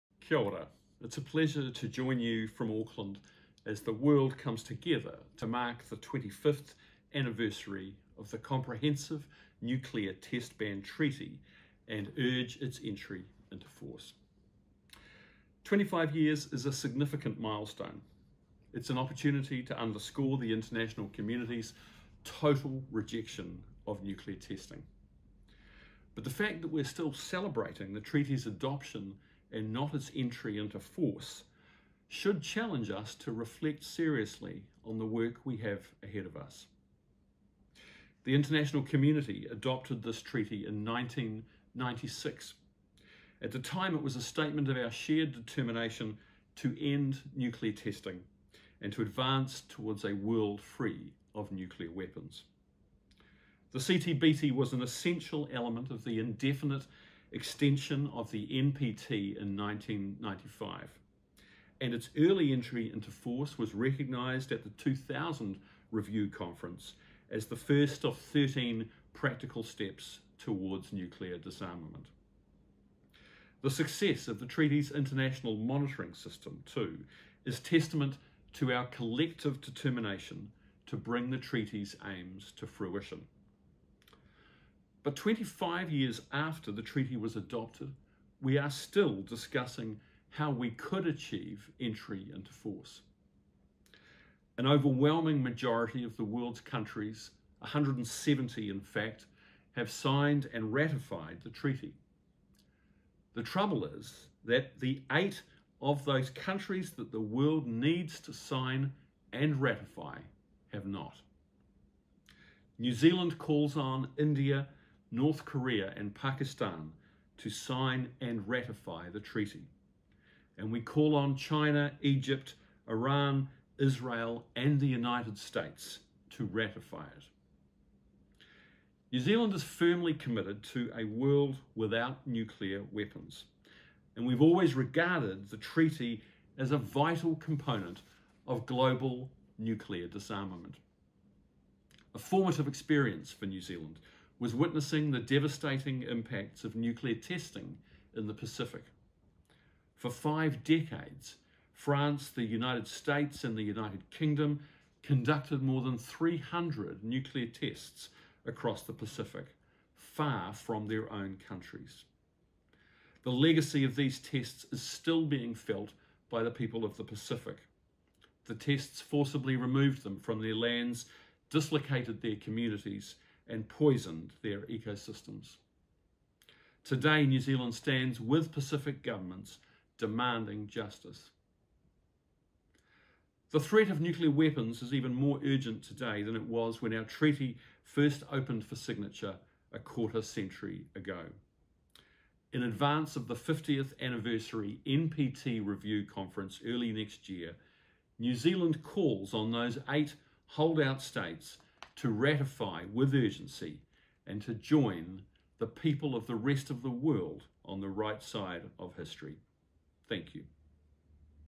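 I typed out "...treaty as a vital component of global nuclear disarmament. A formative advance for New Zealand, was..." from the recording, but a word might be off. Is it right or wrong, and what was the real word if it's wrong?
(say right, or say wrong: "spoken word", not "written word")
wrong: "experience", not "advance".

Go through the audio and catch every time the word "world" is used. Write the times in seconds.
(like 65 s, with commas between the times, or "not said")
3 s, 50 s, 96 s, 107 s, 131 s, 206 s.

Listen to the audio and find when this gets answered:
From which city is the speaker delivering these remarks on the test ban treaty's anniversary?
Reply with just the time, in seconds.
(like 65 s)
2 s.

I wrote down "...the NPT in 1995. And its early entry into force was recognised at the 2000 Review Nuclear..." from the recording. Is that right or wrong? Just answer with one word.
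wrong.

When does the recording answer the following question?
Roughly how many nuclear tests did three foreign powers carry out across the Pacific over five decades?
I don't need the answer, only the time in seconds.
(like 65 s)
155 s.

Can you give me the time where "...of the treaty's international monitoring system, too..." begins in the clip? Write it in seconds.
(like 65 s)
74 s.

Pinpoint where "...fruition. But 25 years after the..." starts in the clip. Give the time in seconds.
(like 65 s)
82 s.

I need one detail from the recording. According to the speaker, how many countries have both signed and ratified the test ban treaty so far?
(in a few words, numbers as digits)
170.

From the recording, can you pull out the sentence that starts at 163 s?
The legacy of these tests is still being felt by the people of the Pacific.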